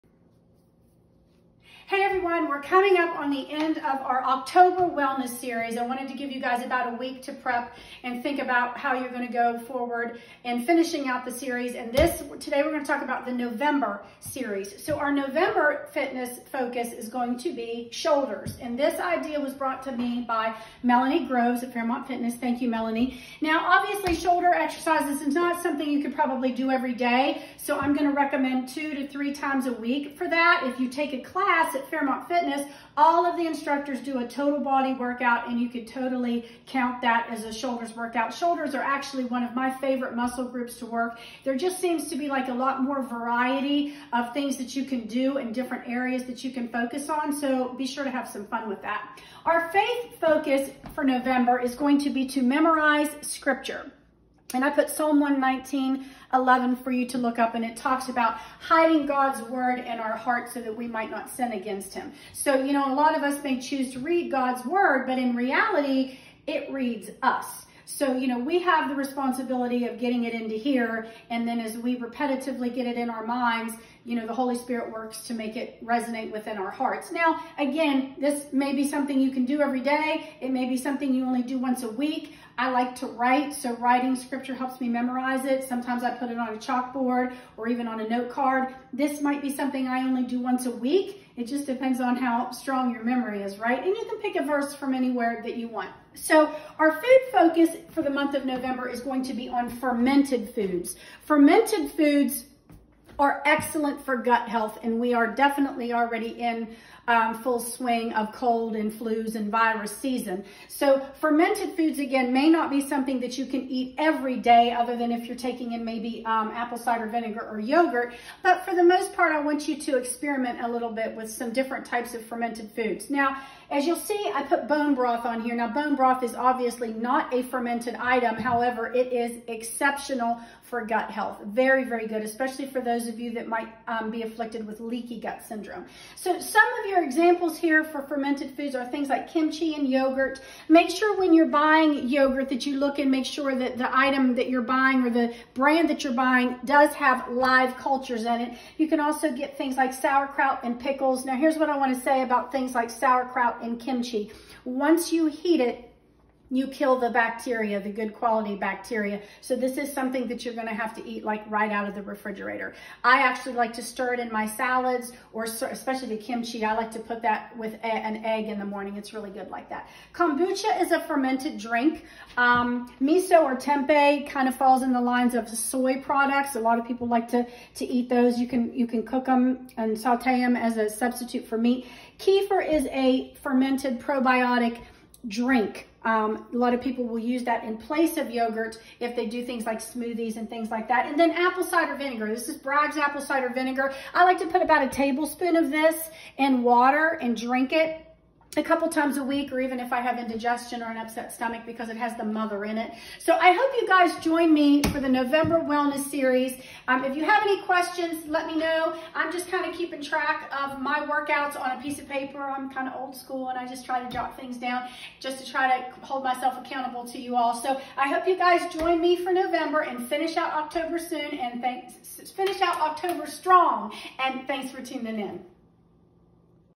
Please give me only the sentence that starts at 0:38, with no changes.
Shoulders are actually one of my favorite muscle groups to work.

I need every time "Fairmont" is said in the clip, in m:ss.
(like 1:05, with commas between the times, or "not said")
0:21, 0:31.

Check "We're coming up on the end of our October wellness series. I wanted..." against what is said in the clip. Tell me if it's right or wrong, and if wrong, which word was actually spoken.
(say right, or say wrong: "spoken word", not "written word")
right.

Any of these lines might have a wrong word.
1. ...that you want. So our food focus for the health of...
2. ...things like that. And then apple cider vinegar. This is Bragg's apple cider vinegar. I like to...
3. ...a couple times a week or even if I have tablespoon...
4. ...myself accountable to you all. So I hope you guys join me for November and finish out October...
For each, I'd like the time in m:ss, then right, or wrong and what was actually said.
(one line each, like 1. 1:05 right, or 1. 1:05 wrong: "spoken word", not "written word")
1. 1:35 wrong: "month", not "health"
2. 3:10 right
3. 3:18 wrong: "indigestion", not "tablespoon"
4. 3:36 right.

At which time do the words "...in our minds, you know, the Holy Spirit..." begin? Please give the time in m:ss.
1:12.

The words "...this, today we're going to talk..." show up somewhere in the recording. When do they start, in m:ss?
0:11.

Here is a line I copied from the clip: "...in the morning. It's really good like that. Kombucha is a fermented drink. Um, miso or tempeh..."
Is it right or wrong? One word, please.
right.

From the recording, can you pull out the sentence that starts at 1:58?
But for the most part, I want you to experiment a little bit with some different types of fermented foods.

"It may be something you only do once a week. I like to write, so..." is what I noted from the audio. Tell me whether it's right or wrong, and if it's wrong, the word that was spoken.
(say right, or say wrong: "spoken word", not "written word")
right.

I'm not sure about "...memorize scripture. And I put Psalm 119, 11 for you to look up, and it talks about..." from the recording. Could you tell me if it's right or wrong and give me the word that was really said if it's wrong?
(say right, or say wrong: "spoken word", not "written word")
right.